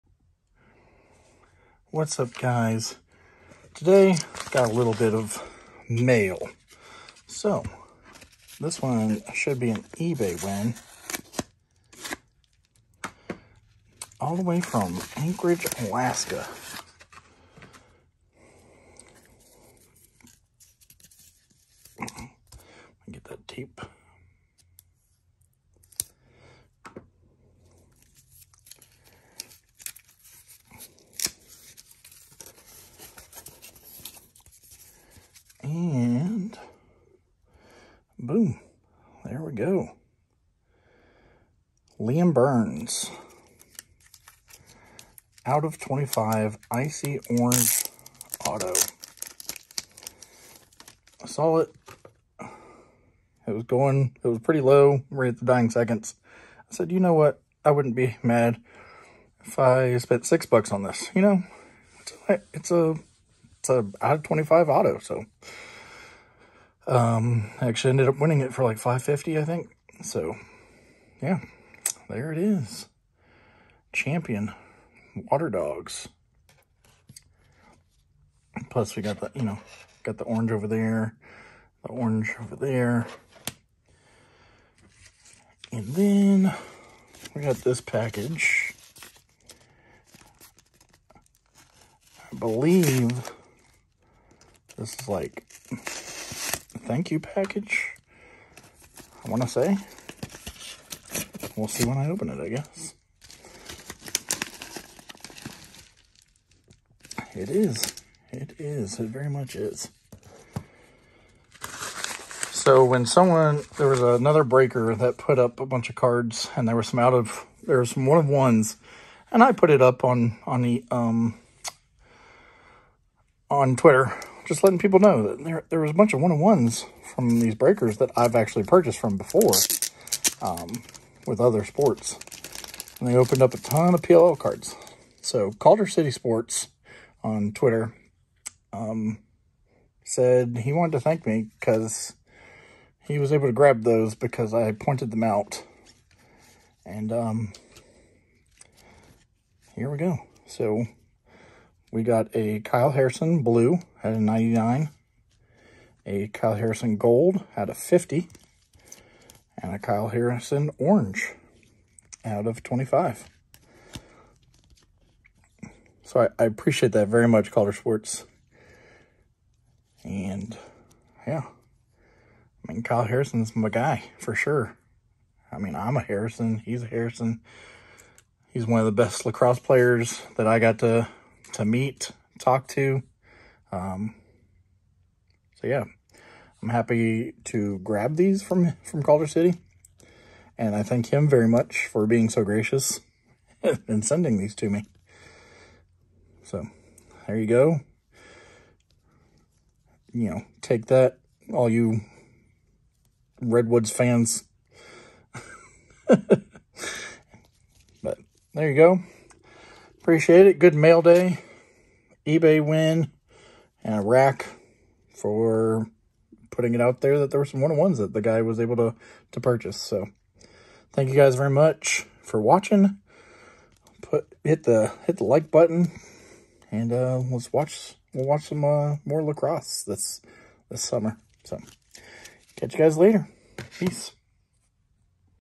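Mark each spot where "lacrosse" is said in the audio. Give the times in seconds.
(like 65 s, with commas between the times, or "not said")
179 s, 229 s.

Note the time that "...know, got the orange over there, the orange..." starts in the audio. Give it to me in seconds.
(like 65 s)
79 s.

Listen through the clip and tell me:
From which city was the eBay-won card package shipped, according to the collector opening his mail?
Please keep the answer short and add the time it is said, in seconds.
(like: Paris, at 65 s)
Anchorage, Alaska, at 15 s.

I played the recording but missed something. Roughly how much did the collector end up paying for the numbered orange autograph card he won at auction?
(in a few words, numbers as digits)
$5.50.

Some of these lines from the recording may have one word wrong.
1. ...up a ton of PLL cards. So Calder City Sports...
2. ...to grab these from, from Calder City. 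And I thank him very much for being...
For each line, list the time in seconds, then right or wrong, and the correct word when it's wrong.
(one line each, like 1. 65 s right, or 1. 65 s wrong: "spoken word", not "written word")
1. 133 s right
2. 187 s right.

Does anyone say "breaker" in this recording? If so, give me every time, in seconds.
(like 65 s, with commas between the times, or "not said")
114 s, 127 s.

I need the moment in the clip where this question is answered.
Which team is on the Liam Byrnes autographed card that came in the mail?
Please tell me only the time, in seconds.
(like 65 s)
75 s.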